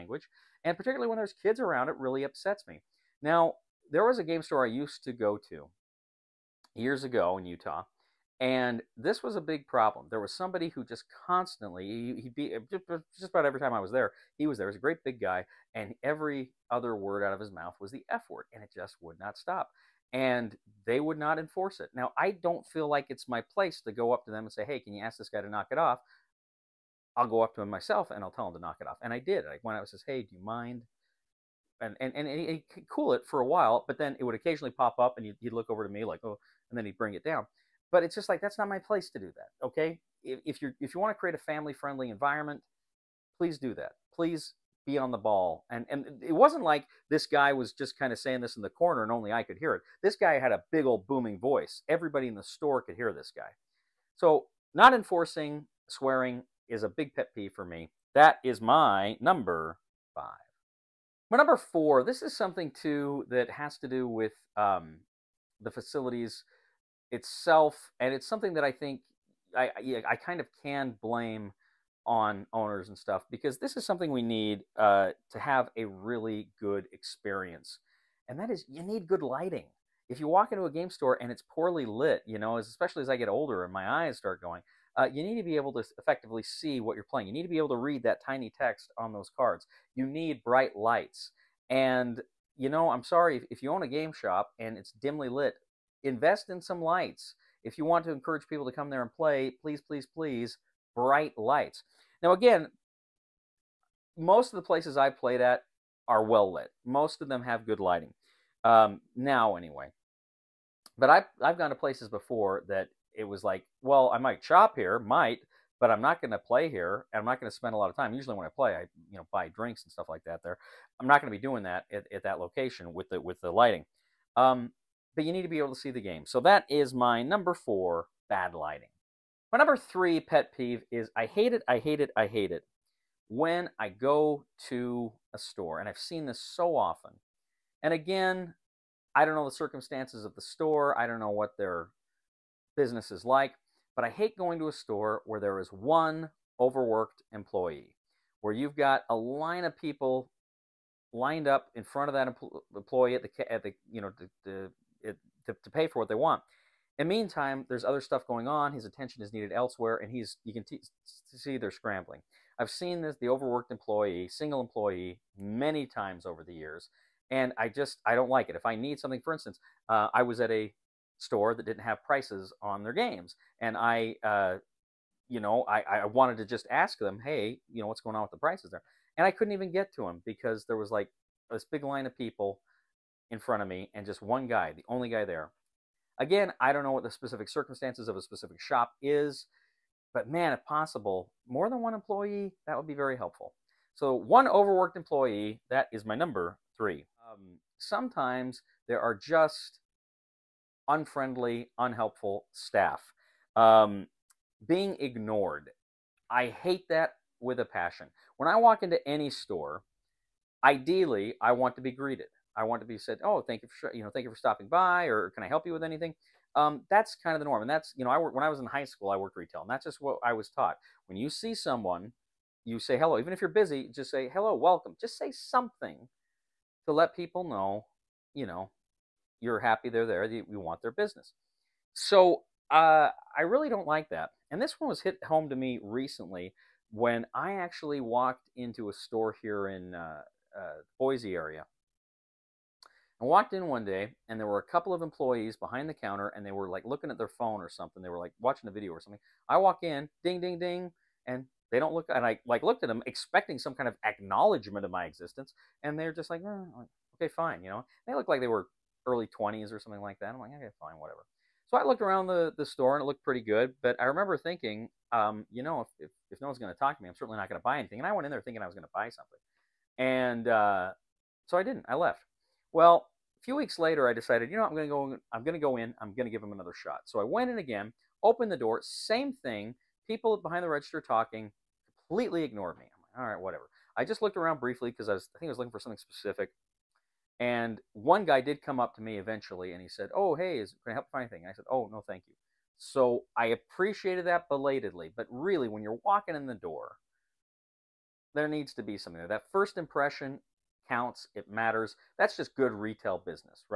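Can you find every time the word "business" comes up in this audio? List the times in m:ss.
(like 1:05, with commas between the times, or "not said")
2:22, 3:50, 5:03.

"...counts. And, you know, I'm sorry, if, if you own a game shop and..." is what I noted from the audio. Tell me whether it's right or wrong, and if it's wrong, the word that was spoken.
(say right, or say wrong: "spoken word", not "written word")
wrong: "lights", not "counts".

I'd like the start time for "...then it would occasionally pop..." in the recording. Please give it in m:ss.
0:33.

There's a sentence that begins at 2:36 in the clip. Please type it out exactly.
In the meantime, there's other stuff going on.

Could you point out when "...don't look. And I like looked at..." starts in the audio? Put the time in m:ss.
4:11.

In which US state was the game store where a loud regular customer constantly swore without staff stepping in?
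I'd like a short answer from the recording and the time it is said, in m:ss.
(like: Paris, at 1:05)
Utah, at 0:07.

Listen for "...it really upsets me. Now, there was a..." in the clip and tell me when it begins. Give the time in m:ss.
0:01.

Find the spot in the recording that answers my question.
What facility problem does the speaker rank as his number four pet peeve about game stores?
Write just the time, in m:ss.
2:08.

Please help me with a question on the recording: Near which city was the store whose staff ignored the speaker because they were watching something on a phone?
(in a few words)
Boise.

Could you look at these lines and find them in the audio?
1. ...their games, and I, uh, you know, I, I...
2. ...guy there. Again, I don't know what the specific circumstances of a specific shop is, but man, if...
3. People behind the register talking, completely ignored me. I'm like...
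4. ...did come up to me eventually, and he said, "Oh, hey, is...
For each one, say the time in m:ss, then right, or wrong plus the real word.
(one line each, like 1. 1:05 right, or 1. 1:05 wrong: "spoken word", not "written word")
1. 2:52 right
2. 3:05 right
3. 4:40 right
4. 4:48 right.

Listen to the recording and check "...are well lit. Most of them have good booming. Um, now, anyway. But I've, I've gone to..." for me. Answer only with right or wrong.
wrong.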